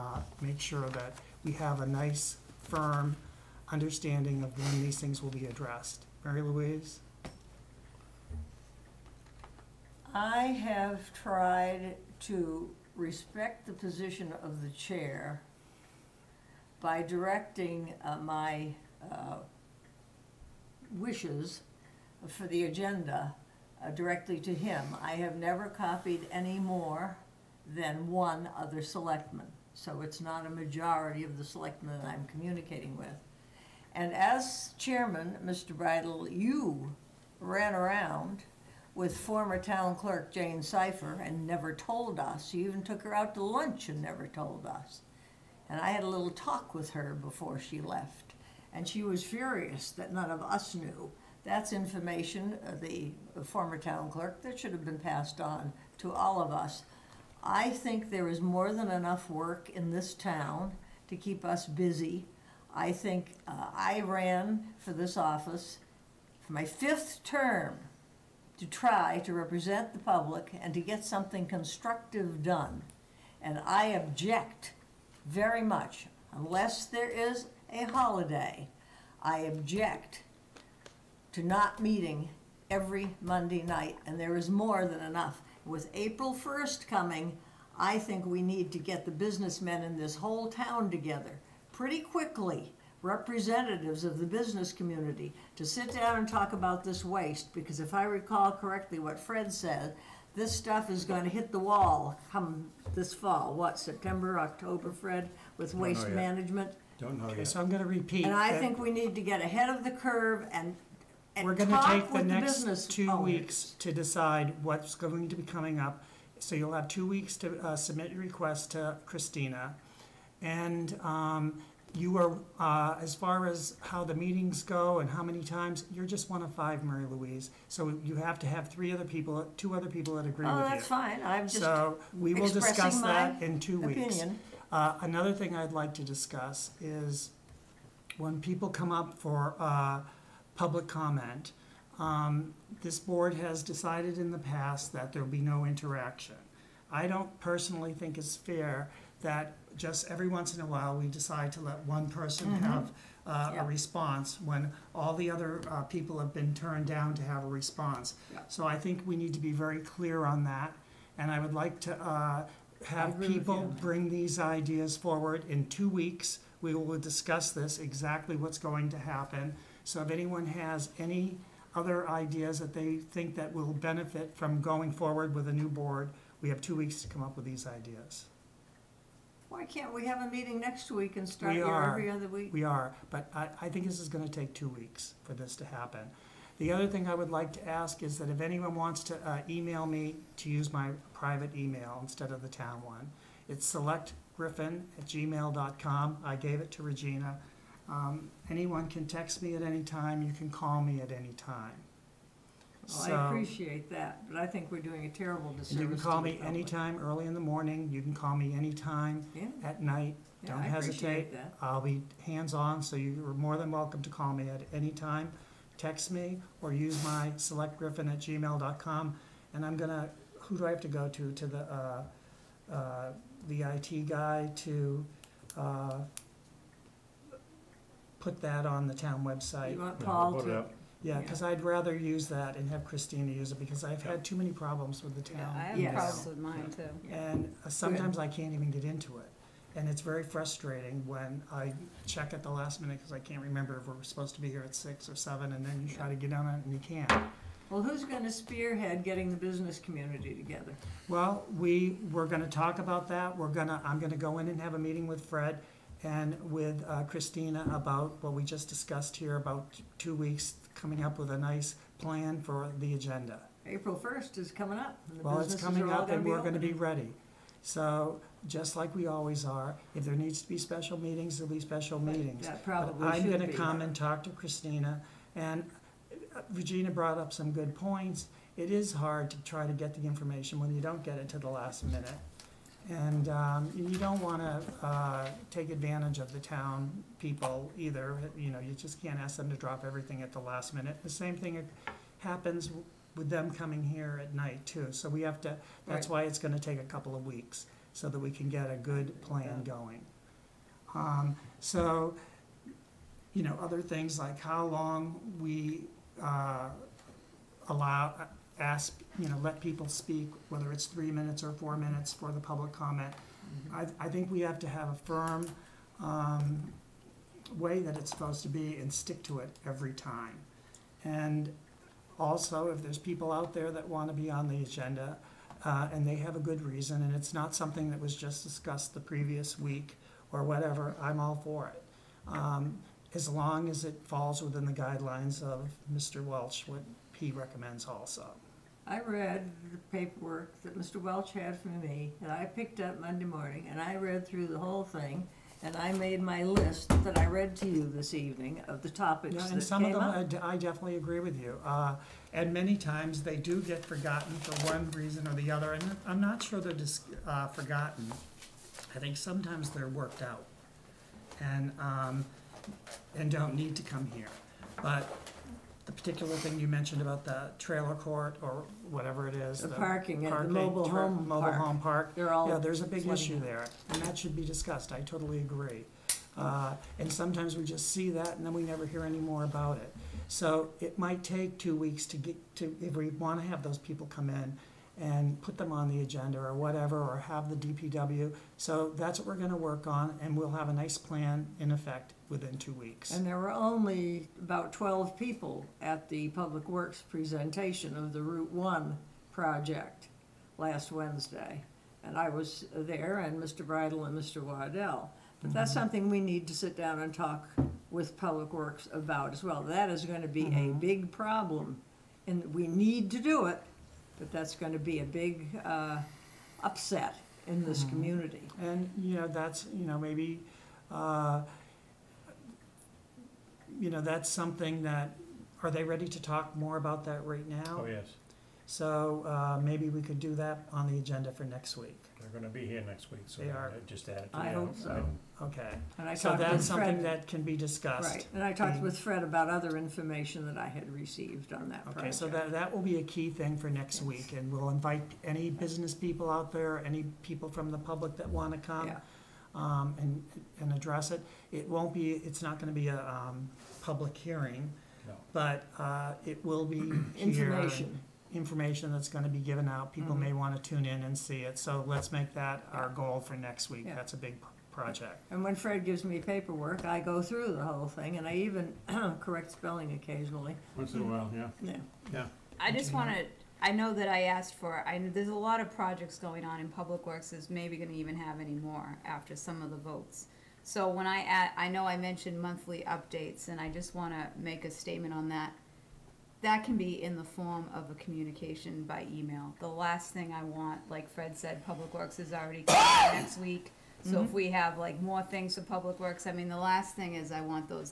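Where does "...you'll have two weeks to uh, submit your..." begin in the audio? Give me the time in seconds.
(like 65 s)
116 s.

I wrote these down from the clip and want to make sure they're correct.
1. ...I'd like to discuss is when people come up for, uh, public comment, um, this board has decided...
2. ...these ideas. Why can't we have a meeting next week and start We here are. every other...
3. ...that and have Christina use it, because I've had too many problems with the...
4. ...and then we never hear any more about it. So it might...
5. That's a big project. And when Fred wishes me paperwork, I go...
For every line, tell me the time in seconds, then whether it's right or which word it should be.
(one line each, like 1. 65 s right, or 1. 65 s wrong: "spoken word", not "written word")
1. 135 s right
2. 177 s right
3. 232 s right
4. 378 s right
5. 463 s wrong: "gives", not "wishes".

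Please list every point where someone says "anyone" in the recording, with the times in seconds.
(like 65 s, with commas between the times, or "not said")
170 s, 188 s, 198 s.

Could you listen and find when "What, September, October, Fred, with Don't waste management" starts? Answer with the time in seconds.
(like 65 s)
103 s.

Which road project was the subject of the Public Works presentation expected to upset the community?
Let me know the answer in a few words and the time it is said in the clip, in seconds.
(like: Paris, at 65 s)
Route One, at 398 s.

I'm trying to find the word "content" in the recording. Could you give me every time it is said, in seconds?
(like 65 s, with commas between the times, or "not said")
not said.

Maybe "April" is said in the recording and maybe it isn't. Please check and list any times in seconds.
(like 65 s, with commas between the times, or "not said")
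85 s, 263 s.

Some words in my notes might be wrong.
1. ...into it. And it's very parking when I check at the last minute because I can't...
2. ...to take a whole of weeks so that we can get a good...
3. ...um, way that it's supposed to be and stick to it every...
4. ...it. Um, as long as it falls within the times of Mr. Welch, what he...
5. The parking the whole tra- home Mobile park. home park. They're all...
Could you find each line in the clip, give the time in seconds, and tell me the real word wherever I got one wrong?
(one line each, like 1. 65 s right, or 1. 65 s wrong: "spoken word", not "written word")
1. 238 s wrong: "frustrating", not "parking"
2. 296 s wrong: "couple", not "whole"
3. 316 s right
4. 331 s wrong: "guidelines", not "times"
5. 369 s wrong: "mobile", not "whole".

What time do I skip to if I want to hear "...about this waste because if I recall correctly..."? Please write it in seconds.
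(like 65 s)
96 s.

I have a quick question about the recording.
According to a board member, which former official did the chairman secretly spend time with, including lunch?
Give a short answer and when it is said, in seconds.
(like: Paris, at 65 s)
Jane Cypher, at 40 s.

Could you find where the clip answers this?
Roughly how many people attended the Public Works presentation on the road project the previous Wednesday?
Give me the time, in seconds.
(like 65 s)
394 s.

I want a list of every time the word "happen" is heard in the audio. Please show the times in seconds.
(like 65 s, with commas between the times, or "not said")
168 s, 185 s, 292 s.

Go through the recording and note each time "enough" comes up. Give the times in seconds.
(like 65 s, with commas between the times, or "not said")
58 s, 85 s.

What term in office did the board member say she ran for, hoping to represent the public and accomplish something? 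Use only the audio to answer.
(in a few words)
fifth term.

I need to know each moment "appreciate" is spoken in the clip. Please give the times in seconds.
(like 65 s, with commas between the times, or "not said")
203 s, 210 s.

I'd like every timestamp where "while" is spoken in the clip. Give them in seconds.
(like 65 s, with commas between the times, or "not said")
150 s, 471 s.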